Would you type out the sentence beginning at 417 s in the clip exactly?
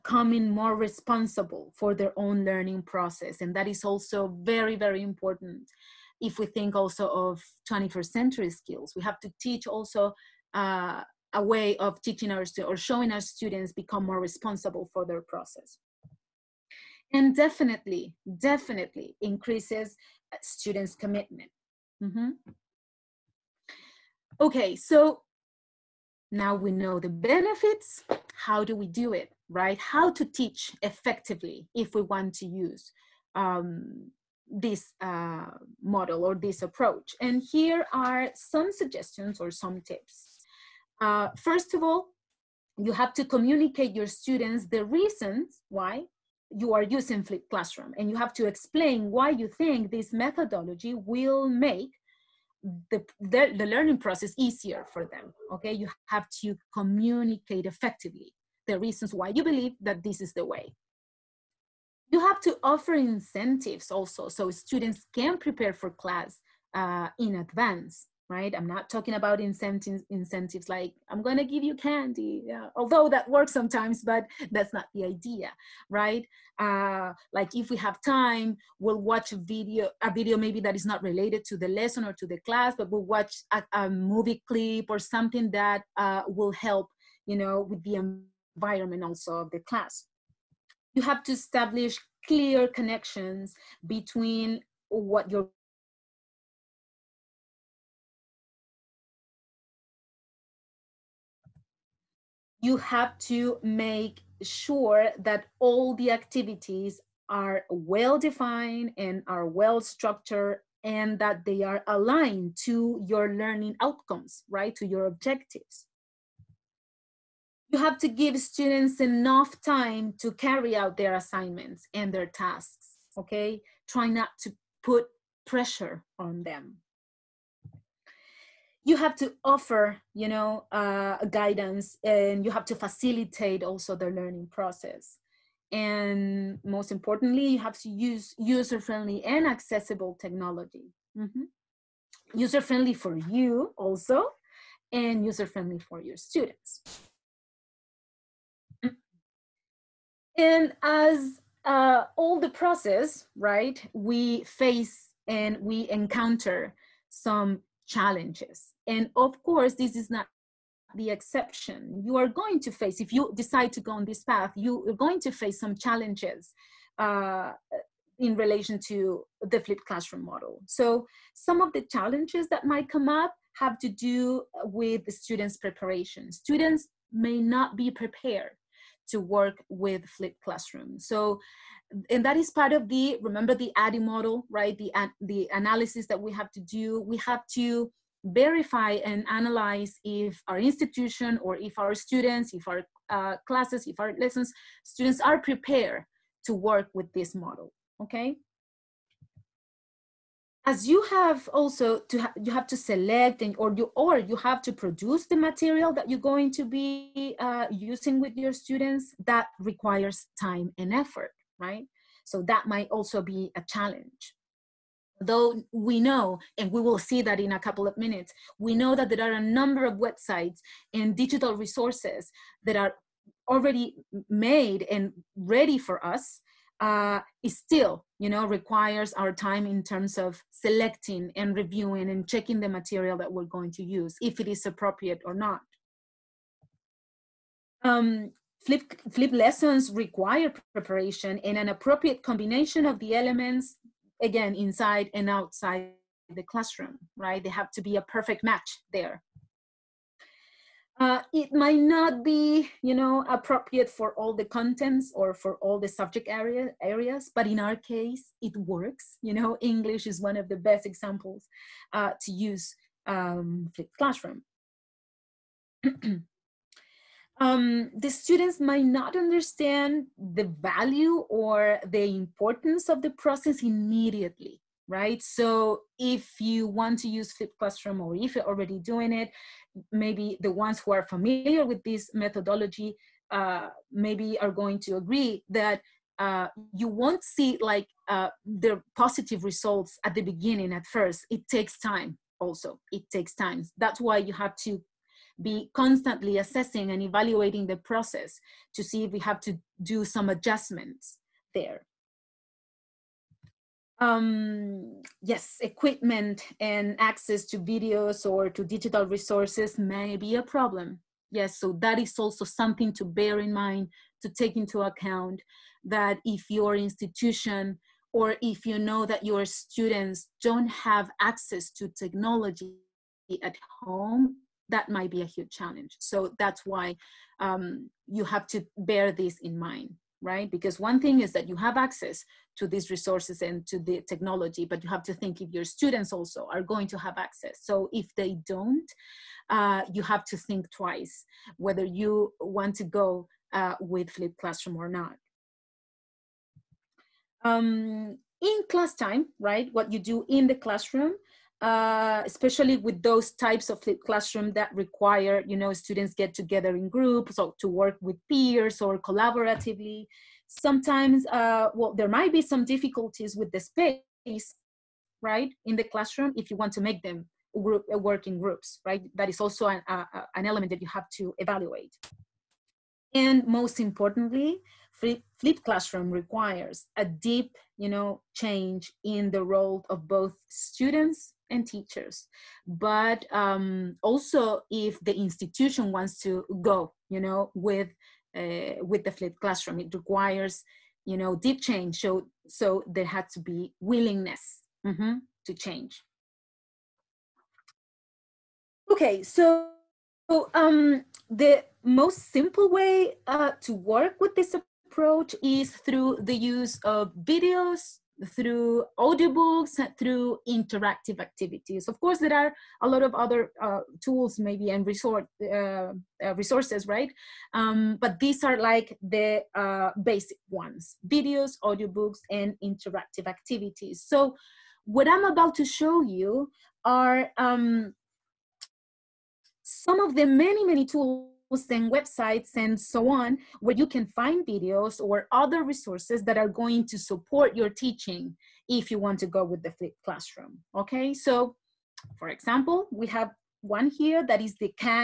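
Um, but these are like the uh, basic ones, videos, audiobooks, and interactive activities.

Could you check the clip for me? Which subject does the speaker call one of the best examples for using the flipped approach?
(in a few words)
English.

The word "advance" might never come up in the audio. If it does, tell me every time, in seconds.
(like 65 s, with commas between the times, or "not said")
67 s.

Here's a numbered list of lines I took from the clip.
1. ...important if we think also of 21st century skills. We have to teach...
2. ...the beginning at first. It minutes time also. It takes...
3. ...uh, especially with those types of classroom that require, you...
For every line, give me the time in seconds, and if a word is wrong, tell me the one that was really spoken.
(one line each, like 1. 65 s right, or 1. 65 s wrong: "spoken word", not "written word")
1. 5 s right
2. 290 s wrong: "takes", not "minutes"
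3. 351 s right.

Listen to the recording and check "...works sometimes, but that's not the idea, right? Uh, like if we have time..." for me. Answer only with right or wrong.
right.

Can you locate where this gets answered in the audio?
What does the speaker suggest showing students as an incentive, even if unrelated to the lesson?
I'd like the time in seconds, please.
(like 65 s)
83 s.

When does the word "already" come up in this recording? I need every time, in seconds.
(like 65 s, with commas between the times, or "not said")
223 s, 278 s.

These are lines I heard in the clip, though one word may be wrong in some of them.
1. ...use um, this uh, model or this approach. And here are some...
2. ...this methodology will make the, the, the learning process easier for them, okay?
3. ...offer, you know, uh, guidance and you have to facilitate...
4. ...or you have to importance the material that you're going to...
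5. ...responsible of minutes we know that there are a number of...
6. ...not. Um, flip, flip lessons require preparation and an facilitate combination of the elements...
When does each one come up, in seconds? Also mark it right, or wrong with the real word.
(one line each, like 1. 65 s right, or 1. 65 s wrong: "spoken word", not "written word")
1. 32 s right
2. 49 s right
3. 129 s right
4. 203 s wrong: "produce", not "importance"
5. 217 s wrong: "couple", not "responsible"
6. 235 s wrong: "appropriate", not "facilitate".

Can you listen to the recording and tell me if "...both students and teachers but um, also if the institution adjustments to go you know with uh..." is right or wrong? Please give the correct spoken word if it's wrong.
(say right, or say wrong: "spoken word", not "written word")
wrong: "wants", not "adjustments".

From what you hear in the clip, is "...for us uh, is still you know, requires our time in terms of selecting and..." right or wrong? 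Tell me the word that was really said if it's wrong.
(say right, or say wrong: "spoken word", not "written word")
right.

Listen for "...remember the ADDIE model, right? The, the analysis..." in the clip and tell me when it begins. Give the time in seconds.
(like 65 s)
183 s.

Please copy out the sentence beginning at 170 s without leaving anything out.
So some of the challenges that might come up have to do with the students' preparation.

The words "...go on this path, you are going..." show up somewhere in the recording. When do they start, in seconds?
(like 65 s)
163 s.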